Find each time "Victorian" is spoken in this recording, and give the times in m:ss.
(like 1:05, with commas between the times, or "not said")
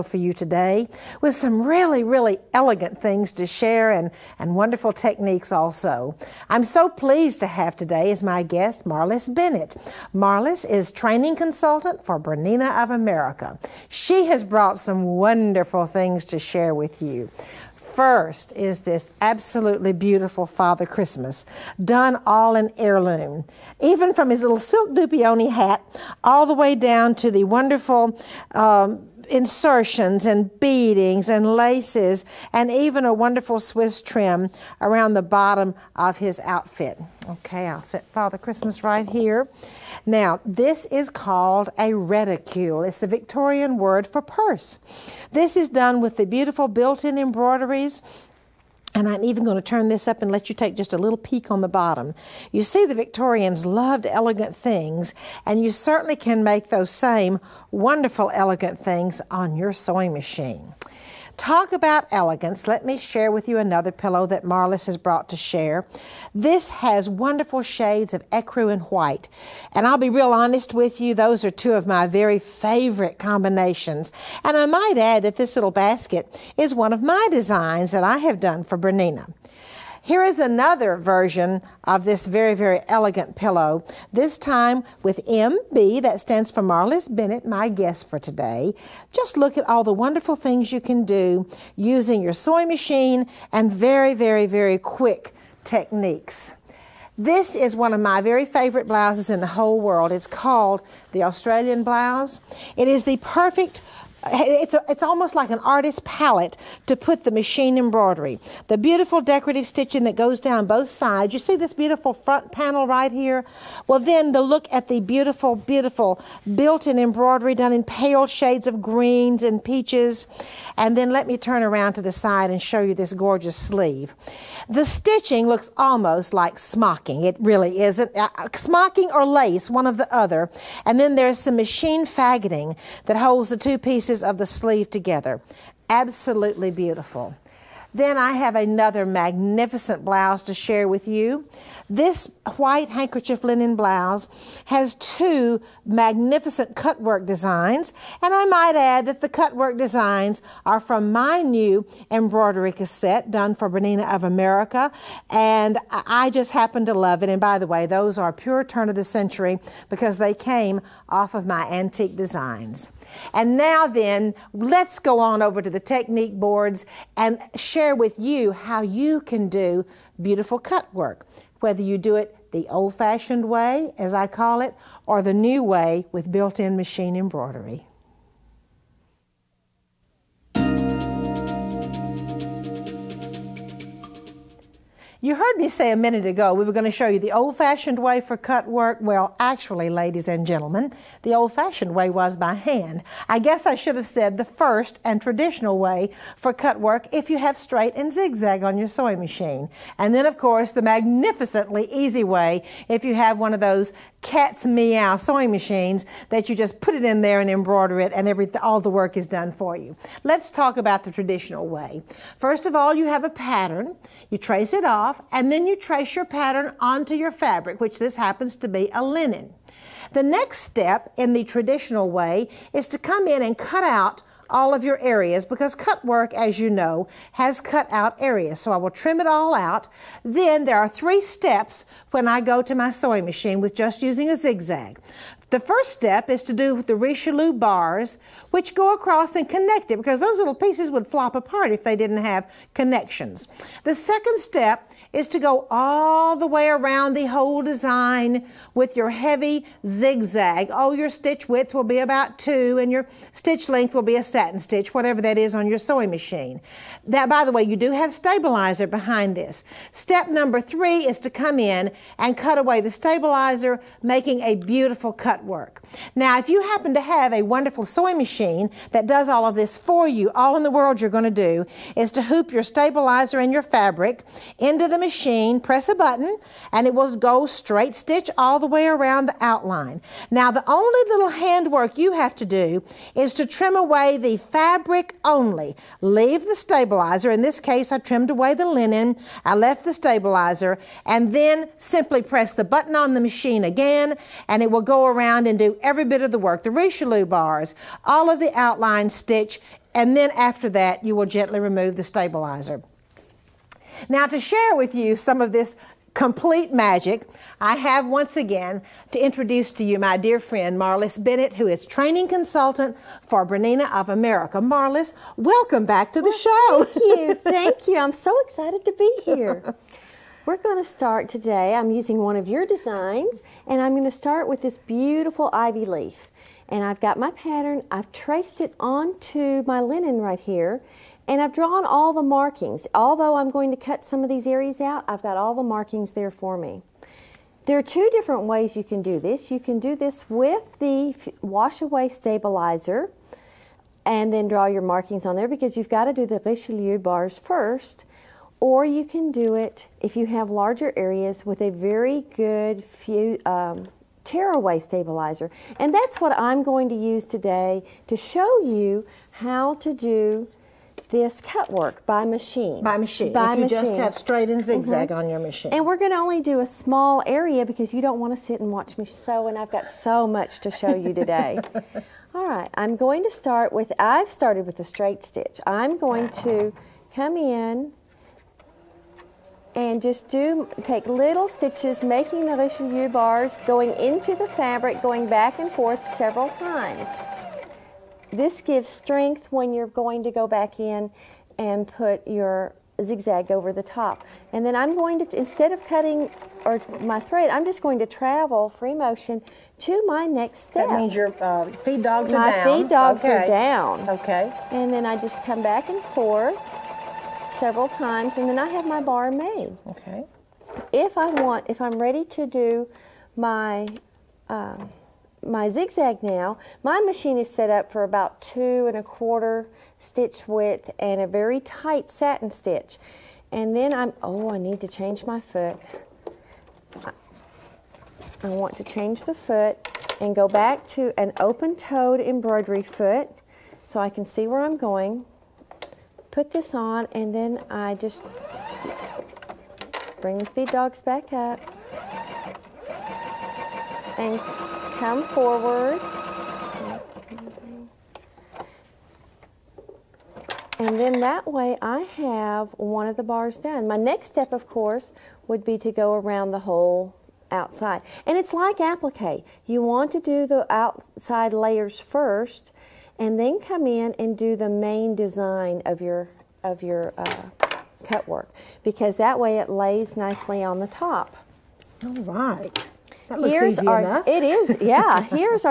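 0:43, 0:52.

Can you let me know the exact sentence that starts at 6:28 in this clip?
This gives strength when you're going to go back in and put your zigzag over the top.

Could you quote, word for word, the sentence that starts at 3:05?
You heard me say a minute ago we were going to show you the old fashioned way for cut work.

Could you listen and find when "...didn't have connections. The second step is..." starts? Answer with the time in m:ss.
4:01.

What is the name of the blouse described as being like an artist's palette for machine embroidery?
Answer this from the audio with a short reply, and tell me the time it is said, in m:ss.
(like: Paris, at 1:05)
Australian blouse, at 1:41.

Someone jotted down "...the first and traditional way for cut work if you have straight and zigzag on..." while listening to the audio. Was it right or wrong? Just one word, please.
right.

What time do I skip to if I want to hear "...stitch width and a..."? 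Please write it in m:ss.
6:59.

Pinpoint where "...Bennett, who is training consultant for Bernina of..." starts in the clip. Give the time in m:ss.
5:11.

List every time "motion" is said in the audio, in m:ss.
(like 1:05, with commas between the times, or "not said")
6:38.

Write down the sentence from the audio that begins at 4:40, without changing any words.
Now, the only little handwork you have to do is to trim away the fabric only.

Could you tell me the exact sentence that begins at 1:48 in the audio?
The beautiful decorative stitching that goes down both sides.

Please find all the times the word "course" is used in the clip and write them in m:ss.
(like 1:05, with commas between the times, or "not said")
3:20, 7:34.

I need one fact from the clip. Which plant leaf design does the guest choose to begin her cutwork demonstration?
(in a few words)
Ivy leaf.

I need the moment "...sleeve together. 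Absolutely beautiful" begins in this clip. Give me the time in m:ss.
2:14.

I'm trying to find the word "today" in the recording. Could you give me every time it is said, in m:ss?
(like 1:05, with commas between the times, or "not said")
0:00, 0:07, 1:28, 5:21, 5:57, 6:11.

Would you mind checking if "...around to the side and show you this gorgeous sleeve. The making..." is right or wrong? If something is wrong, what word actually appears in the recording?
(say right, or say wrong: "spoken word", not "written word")
wrong: "stitching", not "making".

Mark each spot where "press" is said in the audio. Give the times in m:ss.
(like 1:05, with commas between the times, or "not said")
4:35, 4:52.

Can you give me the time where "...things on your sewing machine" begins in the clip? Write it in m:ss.
0:58.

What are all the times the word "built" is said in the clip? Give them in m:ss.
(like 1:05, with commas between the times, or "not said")
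0:46, 1:56, 2:56.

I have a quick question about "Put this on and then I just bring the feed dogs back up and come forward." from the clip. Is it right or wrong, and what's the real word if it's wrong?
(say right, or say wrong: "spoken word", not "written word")
right.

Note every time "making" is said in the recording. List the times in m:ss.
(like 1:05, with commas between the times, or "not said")
4:24, 6:22.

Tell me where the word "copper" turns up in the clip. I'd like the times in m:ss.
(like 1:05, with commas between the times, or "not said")
not said.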